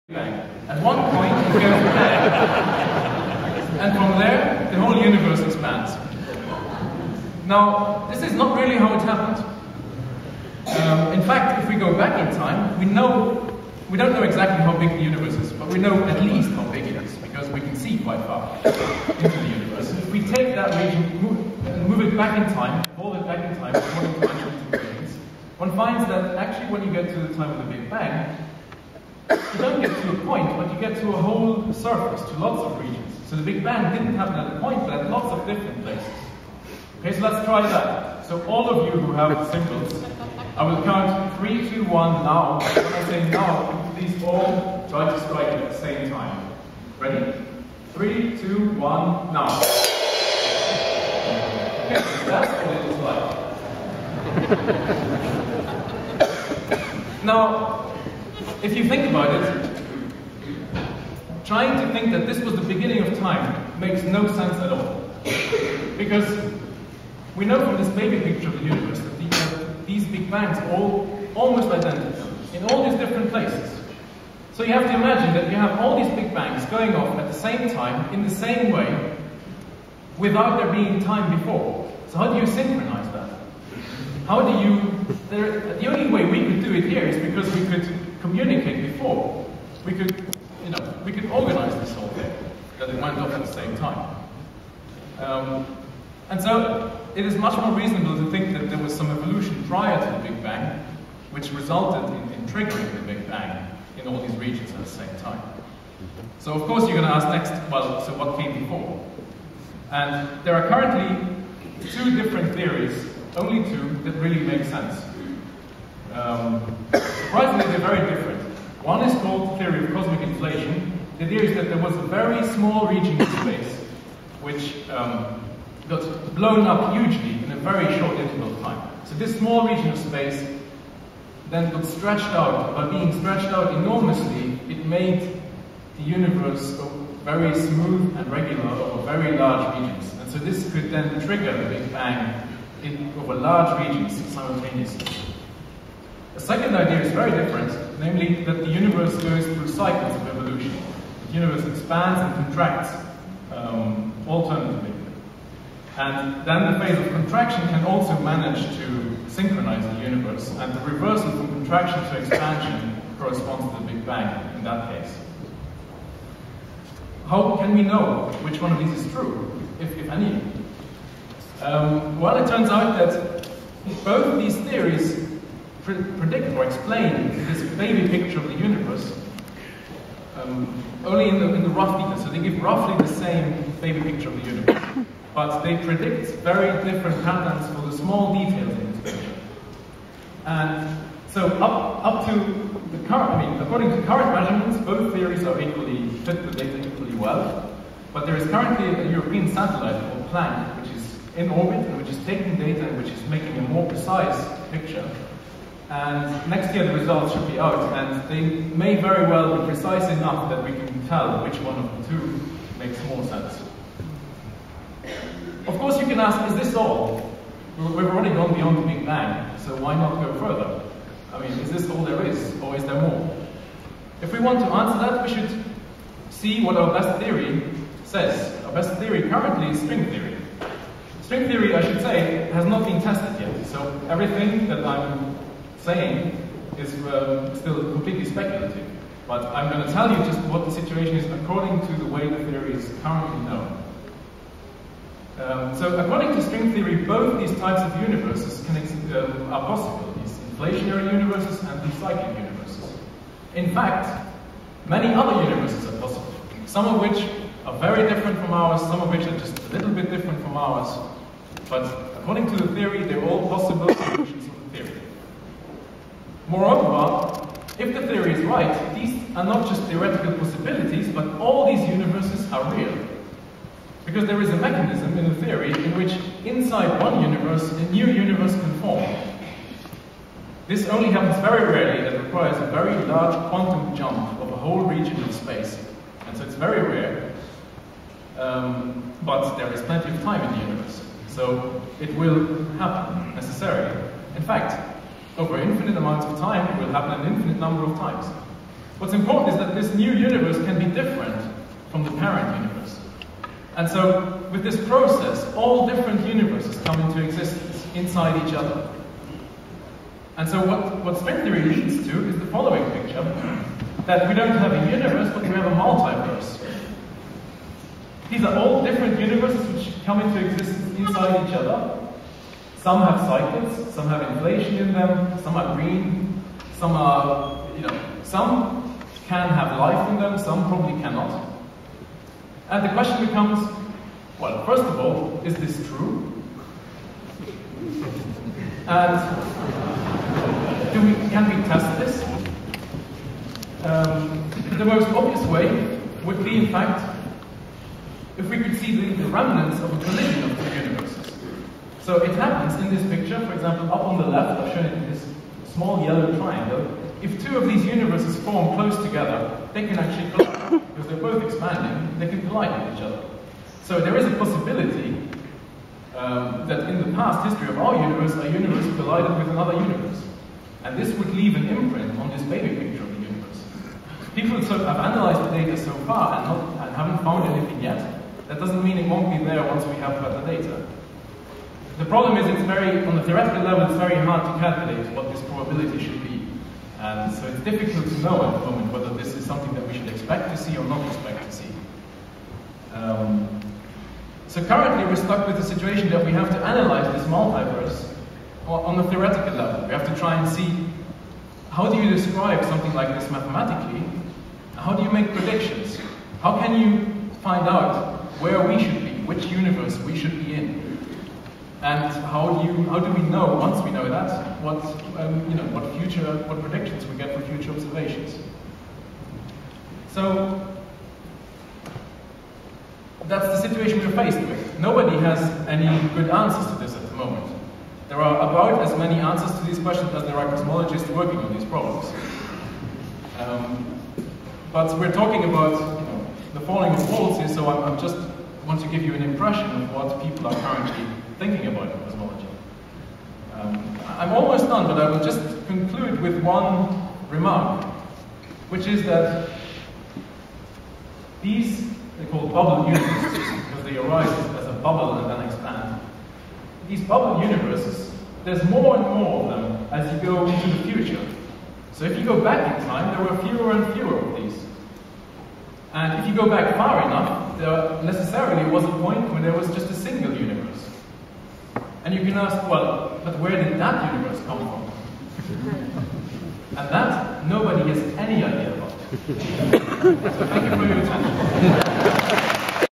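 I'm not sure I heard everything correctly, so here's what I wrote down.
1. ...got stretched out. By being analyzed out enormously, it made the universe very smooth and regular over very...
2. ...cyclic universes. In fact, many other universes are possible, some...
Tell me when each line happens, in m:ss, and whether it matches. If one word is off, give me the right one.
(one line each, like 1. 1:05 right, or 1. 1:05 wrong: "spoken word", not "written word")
1. 2:11 wrong: "stretched", not "analyzed"
2. 4:11 right.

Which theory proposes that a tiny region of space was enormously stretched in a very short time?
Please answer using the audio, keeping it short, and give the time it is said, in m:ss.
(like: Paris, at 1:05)
Cosmic inflation, at 1:59.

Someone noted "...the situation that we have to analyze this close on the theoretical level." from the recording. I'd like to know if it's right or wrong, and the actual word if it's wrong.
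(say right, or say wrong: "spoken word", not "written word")
wrong: "multiverse", not "close".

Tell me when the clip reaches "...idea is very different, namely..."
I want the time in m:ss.
2:26.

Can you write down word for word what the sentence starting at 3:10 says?
And so up, up to the current, I mean, according to current measurements, both theories are equally, fit the data equally well.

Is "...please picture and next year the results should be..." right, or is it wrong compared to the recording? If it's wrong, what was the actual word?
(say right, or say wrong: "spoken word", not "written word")
wrong: "precise", not "please".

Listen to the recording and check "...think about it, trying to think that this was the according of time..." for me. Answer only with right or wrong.
wrong.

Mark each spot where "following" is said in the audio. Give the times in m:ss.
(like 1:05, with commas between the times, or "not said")
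5:12.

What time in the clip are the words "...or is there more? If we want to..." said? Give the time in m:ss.
3:42.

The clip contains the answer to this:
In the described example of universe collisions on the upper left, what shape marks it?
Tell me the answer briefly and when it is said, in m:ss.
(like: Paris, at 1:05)
Small yellow triangle, at 5:55.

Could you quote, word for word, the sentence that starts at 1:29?
We could, you know, we could organize this whole thing, that it went off at the same time.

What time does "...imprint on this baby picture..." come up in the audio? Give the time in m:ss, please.
6:11.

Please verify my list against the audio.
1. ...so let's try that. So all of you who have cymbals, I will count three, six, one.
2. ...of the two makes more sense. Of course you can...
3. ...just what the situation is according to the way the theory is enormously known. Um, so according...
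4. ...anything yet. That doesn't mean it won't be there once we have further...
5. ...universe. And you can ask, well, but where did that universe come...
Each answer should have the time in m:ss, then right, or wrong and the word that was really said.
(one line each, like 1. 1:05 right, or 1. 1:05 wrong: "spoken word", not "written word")
1. 0:37 wrong: "two", not "six"
2. 3:31 right
3. 4:00 wrong: "currently", not "enormously"
4. 6:17 right
5. 7:50 right.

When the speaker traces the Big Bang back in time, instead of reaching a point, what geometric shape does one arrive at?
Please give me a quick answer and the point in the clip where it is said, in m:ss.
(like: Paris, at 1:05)
A whole surface, at 0:31.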